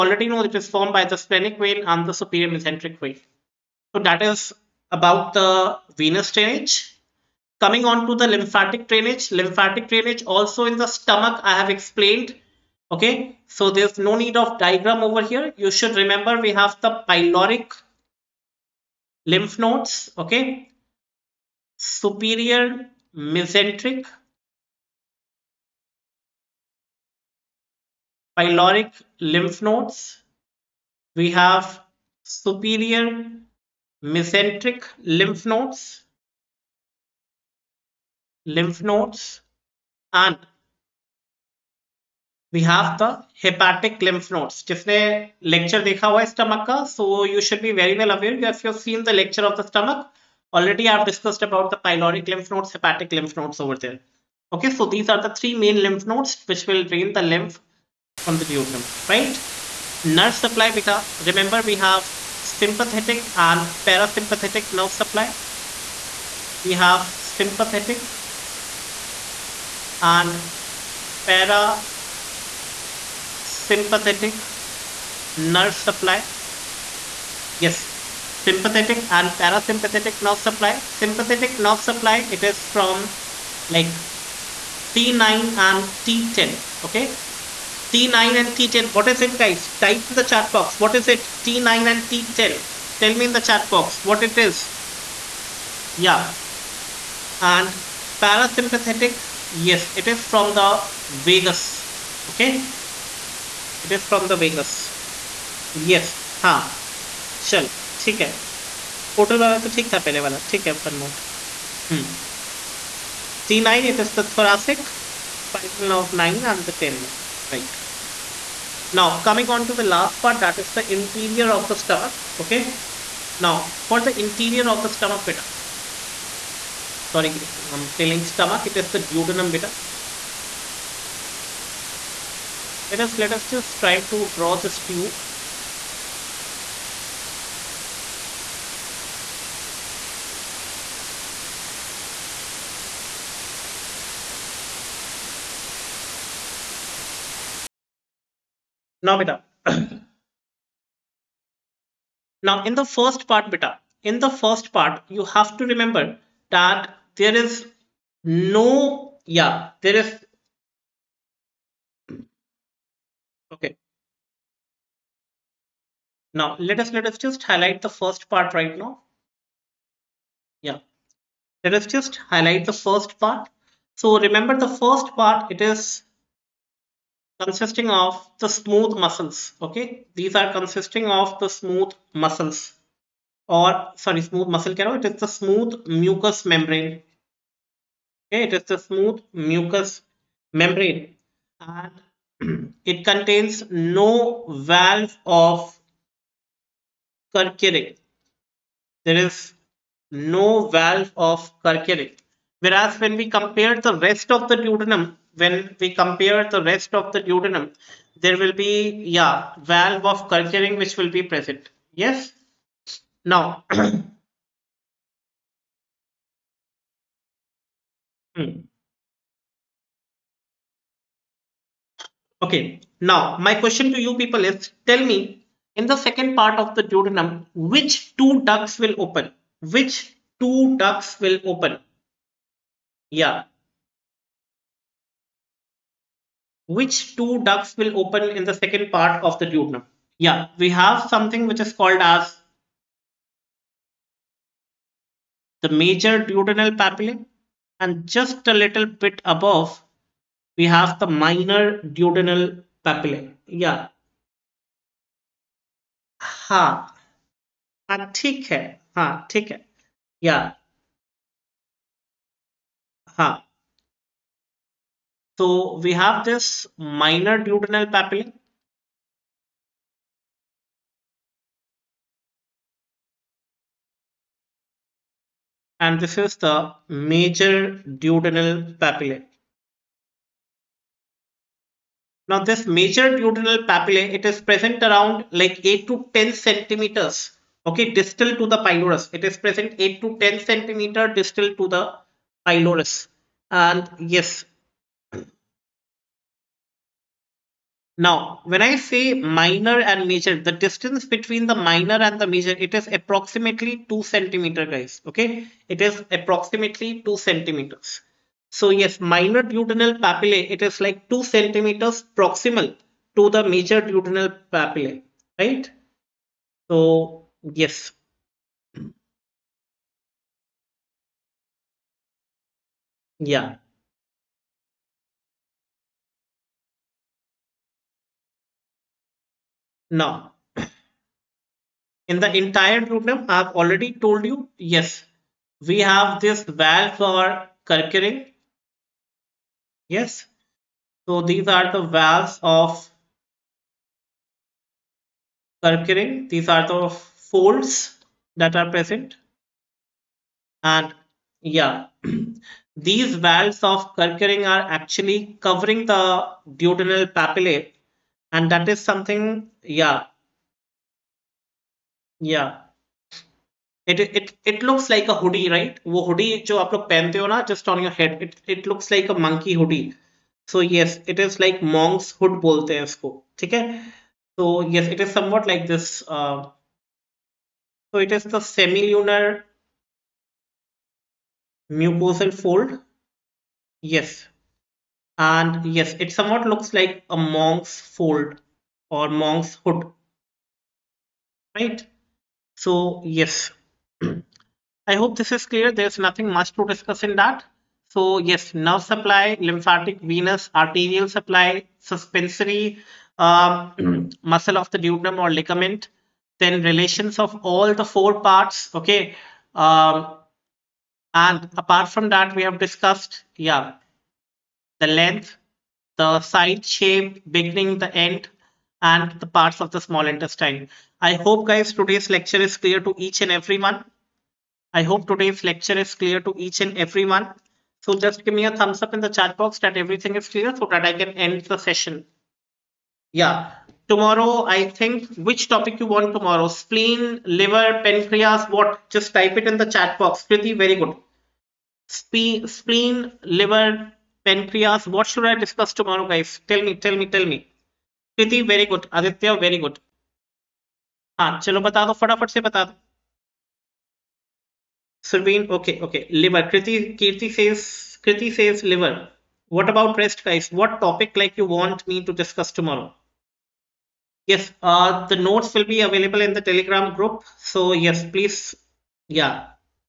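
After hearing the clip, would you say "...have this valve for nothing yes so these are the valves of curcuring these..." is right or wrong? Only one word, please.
wrong.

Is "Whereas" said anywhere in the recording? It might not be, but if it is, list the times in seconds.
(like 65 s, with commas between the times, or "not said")
202 s.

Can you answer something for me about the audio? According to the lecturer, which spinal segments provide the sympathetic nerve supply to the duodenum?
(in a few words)
T9 and T10.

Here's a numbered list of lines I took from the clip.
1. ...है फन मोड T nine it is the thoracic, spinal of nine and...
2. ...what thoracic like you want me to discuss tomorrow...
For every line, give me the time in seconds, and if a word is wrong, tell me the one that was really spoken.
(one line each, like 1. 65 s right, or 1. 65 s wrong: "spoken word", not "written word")
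1. 110 s right
2. 460 s wrong: "topic", not "thoracic".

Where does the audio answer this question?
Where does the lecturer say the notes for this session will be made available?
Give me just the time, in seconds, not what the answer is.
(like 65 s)
466 s.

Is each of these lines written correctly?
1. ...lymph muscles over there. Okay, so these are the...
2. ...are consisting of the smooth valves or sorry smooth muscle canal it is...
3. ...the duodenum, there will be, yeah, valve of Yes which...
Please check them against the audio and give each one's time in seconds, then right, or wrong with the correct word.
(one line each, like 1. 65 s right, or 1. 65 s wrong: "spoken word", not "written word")
1. 53 s wrong: "nodes", not "muscles"
2. 180 s wrong: "muscles", not "valves"
3. 207 s wrong: "Kerkerick", not "Yes".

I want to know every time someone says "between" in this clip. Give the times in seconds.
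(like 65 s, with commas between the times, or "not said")
301 s.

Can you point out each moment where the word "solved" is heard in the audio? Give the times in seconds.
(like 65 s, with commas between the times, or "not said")
not said.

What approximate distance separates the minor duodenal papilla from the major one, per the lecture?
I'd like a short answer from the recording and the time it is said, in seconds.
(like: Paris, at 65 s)
2 centimeters, at 302 s.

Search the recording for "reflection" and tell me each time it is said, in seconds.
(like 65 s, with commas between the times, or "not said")
not said.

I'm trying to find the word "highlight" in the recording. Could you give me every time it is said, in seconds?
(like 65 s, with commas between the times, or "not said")
167 s, 172 s.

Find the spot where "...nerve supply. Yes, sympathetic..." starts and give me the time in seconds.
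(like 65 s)
75 s.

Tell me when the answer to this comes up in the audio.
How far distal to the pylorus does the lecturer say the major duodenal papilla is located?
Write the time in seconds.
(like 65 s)
285 s.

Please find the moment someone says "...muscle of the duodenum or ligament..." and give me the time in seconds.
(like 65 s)
404 s.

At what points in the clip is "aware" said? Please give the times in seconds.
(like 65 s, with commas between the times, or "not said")
48 s.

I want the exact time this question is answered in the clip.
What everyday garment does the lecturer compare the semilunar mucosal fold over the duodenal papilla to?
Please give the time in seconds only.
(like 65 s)
371 s.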